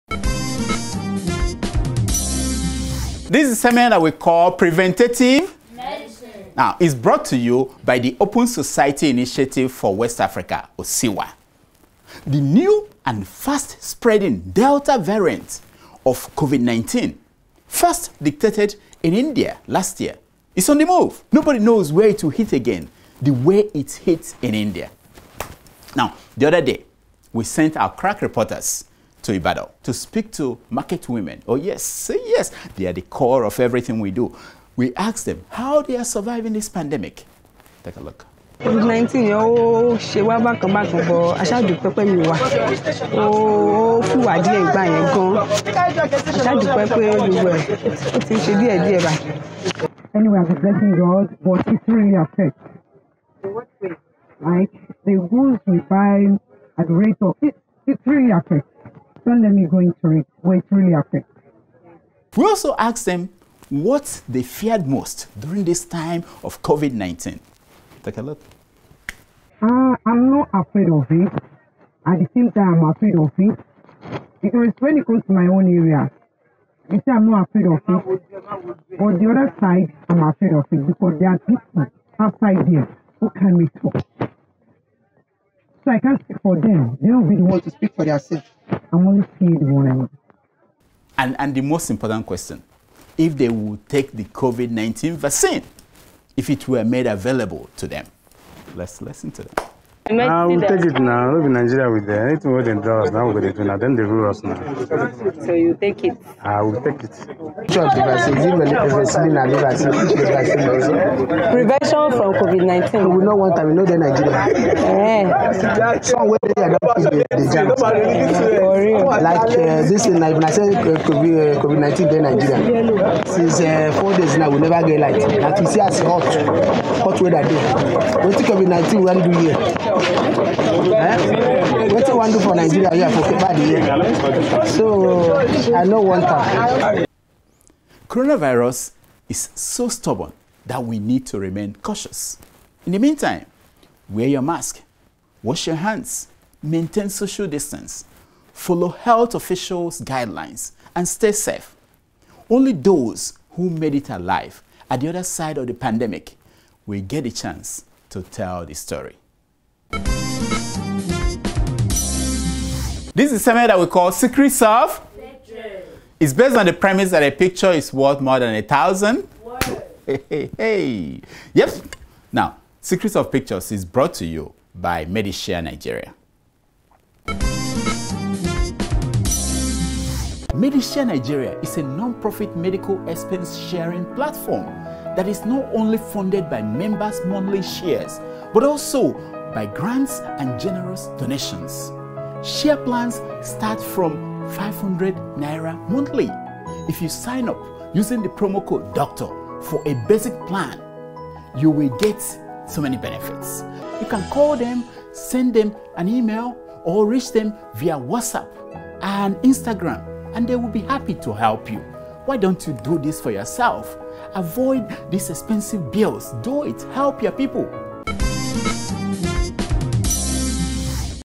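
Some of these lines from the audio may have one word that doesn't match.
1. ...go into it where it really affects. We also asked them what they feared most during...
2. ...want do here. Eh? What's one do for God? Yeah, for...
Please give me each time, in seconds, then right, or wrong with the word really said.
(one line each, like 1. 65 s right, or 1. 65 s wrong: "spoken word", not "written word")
1. 59 s right
2. 129 s wrong: "Nigeria", not "God".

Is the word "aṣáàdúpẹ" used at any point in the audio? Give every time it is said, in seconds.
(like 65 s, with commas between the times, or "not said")
41 s, 46 s.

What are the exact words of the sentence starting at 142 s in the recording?
In the meantime, wear your mask, wash your hands, maintain social distance, follow health officials' guidelines, and stay safe.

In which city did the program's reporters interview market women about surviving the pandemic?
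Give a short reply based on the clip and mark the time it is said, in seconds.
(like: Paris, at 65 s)
Ibadan, at 29 s.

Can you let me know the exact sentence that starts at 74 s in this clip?
Because when it comes to my own area, you say I'm not afraid of it.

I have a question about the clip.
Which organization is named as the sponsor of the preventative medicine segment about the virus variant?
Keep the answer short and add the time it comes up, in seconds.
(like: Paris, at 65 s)
Open Society Initiative for West Africa, at 8 s.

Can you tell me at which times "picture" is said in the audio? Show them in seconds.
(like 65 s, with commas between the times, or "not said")
167 s, 173 s.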